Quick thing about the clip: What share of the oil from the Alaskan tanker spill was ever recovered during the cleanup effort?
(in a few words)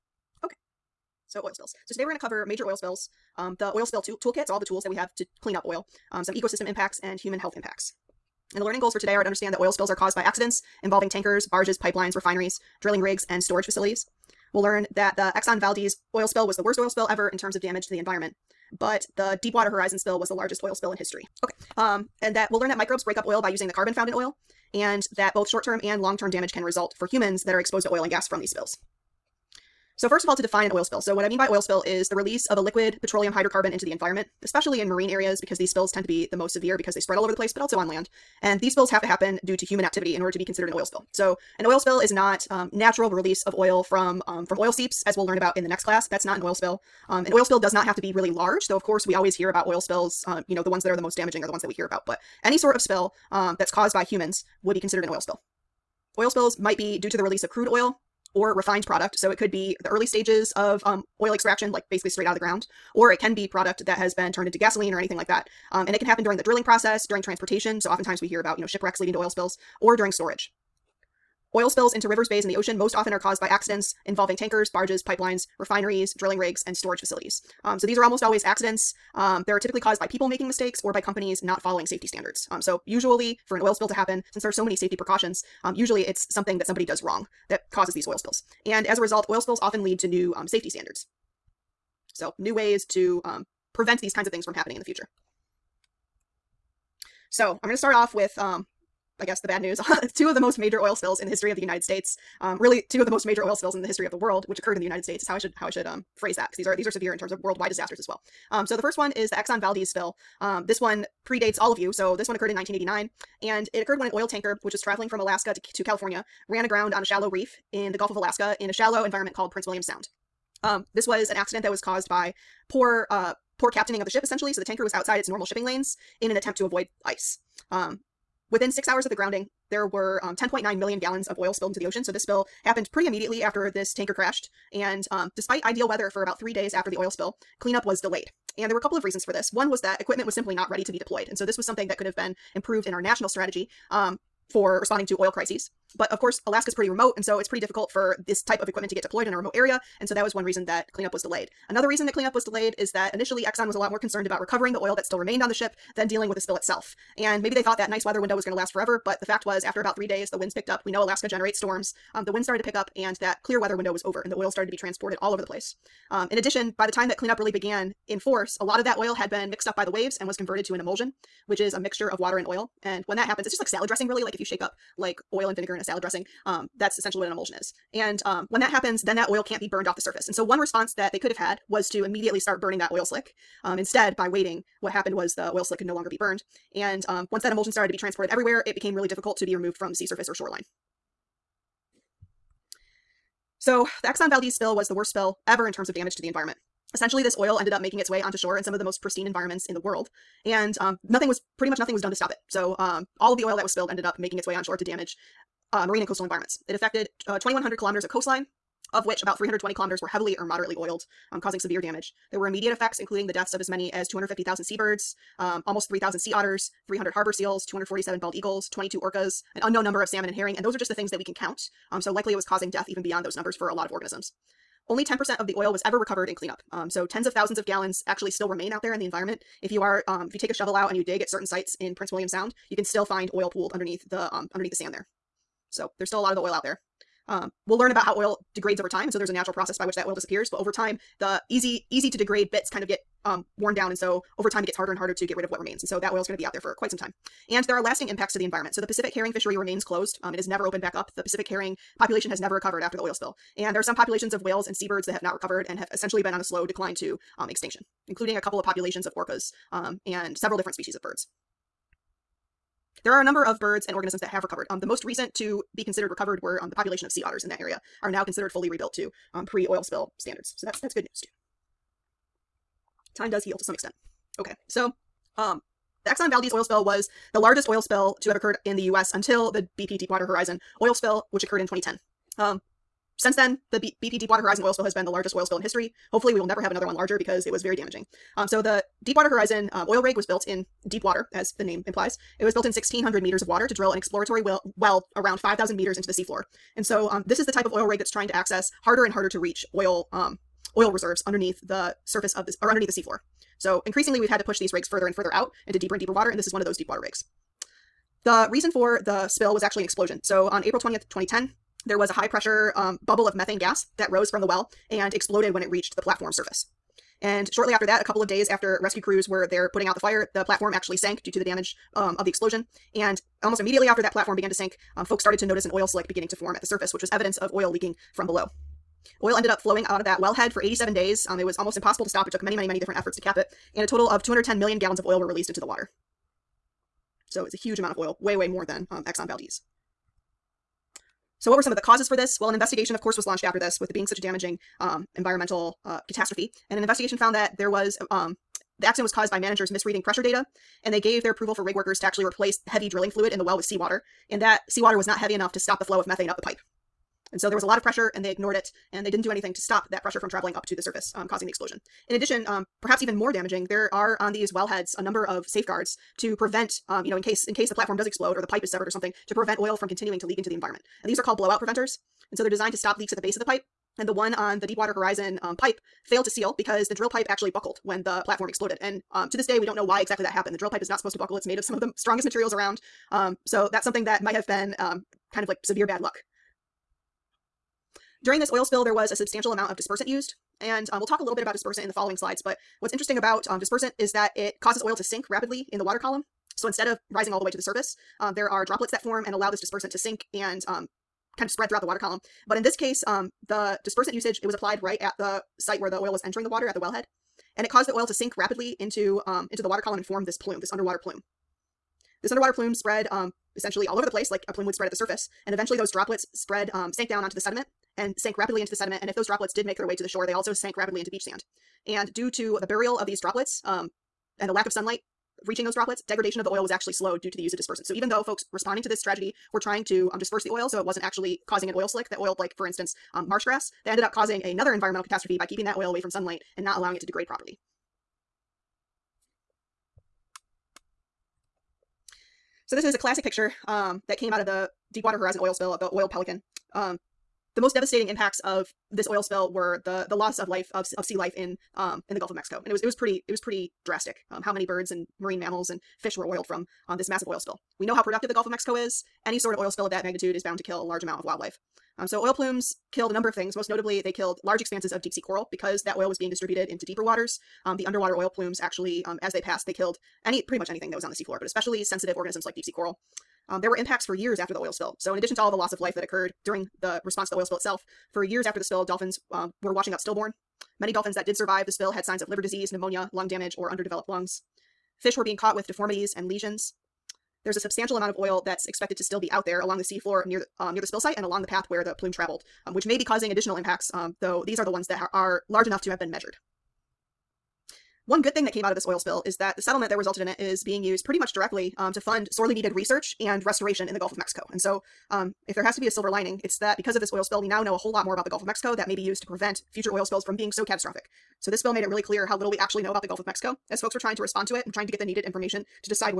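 10%.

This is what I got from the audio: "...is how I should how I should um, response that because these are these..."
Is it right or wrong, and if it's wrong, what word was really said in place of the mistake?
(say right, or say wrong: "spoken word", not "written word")
wrong: "phrase", not "response".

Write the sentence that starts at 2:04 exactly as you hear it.
So the tanker was outside its normal shipping lanes in an attempt to avoid ice.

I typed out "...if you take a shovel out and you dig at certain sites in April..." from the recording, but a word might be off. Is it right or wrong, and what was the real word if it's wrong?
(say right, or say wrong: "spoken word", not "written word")
wrong: "Prince", not "April".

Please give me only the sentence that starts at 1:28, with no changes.
And as a result, oil spills often lead to new um, safety standards.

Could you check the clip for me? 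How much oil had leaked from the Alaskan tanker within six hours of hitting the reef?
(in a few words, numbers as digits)
10.9 million gallons.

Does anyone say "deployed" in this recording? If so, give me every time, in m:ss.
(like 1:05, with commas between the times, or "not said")
2:20, 2:29.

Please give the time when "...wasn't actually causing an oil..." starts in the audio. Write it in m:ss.
7:10.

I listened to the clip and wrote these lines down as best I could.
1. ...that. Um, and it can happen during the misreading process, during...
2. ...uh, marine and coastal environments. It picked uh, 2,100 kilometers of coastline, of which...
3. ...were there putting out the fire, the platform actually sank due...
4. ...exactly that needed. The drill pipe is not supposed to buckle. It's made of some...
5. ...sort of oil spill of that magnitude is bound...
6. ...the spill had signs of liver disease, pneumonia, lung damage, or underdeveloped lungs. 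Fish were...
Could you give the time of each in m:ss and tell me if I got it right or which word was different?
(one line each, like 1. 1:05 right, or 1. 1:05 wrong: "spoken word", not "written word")
1. 1:05 wrong: "drilling", not "misreading"
2. 3:25 wrong: "affected", not "picked"
3. 5:19 right
4. 6:20 wrong: "happened", not "needed"
5. 7:39 right
6. 8:01 right.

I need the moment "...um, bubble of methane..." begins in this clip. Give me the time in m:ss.
5:12.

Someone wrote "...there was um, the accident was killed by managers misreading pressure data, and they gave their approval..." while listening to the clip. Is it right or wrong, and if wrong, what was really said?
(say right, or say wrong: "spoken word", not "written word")
wrong: "caused", not "killed".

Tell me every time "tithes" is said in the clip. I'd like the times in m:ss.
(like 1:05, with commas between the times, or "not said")
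not said.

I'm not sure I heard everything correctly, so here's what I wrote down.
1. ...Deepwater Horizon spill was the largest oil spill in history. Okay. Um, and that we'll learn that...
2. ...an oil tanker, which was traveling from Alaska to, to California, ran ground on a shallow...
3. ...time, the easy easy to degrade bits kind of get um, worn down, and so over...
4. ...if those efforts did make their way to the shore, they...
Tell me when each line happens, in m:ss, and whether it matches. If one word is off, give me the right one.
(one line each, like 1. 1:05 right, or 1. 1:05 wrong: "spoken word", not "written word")
1. 0:19 right
2. 1:54 wrong: "aground", not "ground"
3. 4:00 right
4. 6:59 wrong: "droplets", not "efforts".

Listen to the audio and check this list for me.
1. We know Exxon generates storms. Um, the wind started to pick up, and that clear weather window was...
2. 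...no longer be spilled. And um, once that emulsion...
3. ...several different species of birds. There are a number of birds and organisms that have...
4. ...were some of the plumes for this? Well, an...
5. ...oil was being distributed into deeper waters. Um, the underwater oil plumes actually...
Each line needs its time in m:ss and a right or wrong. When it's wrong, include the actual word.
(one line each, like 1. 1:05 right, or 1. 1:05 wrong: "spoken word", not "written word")
1. 2:40 wrong: "Alaska", not "Exxon"
2. 3:05 wrong: "burned", not "spilled"
3. 4:20 right
4. 5:41 wrong: "causes", not "plumes"
5. 7:45 right.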